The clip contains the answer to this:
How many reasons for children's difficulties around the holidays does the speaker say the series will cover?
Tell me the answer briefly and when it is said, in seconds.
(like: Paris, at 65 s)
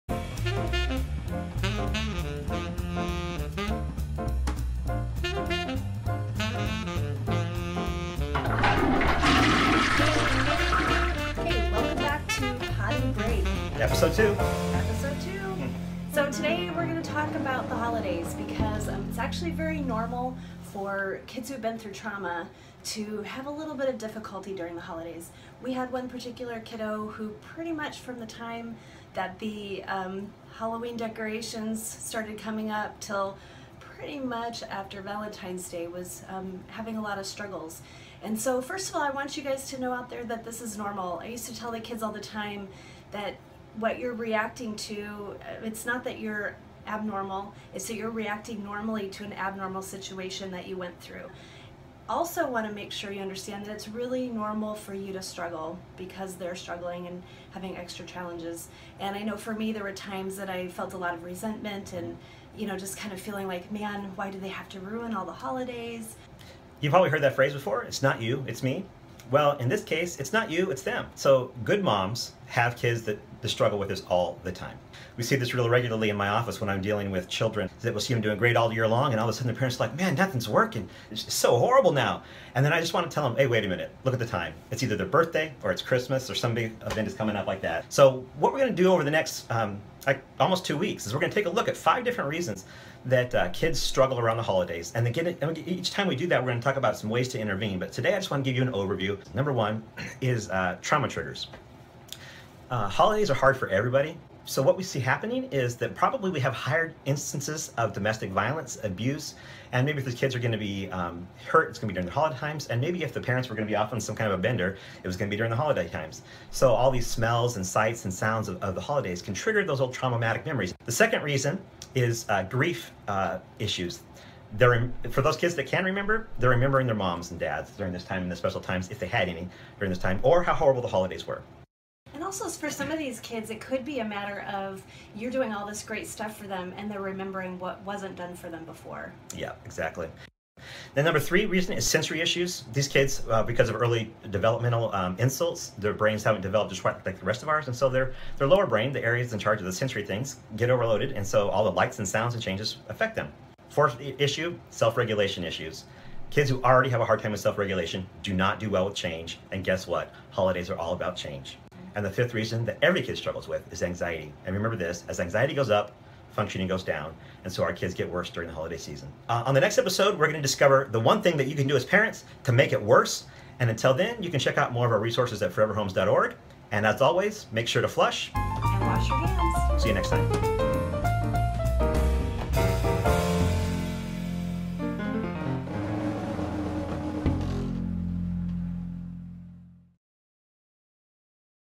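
5, at 91 s.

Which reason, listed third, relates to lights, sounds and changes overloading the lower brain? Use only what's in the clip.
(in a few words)
sensory issues.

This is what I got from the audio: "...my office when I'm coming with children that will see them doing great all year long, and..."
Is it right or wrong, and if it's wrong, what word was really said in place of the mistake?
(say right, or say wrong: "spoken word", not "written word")
wrong: "dealing", not "coming".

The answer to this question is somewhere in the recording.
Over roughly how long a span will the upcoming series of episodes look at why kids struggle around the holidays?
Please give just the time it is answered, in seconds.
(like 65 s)
90 s.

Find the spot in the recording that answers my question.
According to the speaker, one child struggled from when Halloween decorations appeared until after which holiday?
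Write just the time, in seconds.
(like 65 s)
35 s.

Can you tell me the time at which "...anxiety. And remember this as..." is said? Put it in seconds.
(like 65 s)
163 s.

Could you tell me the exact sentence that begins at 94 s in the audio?
And each time we do that, we're going to talk about some ways to intervene.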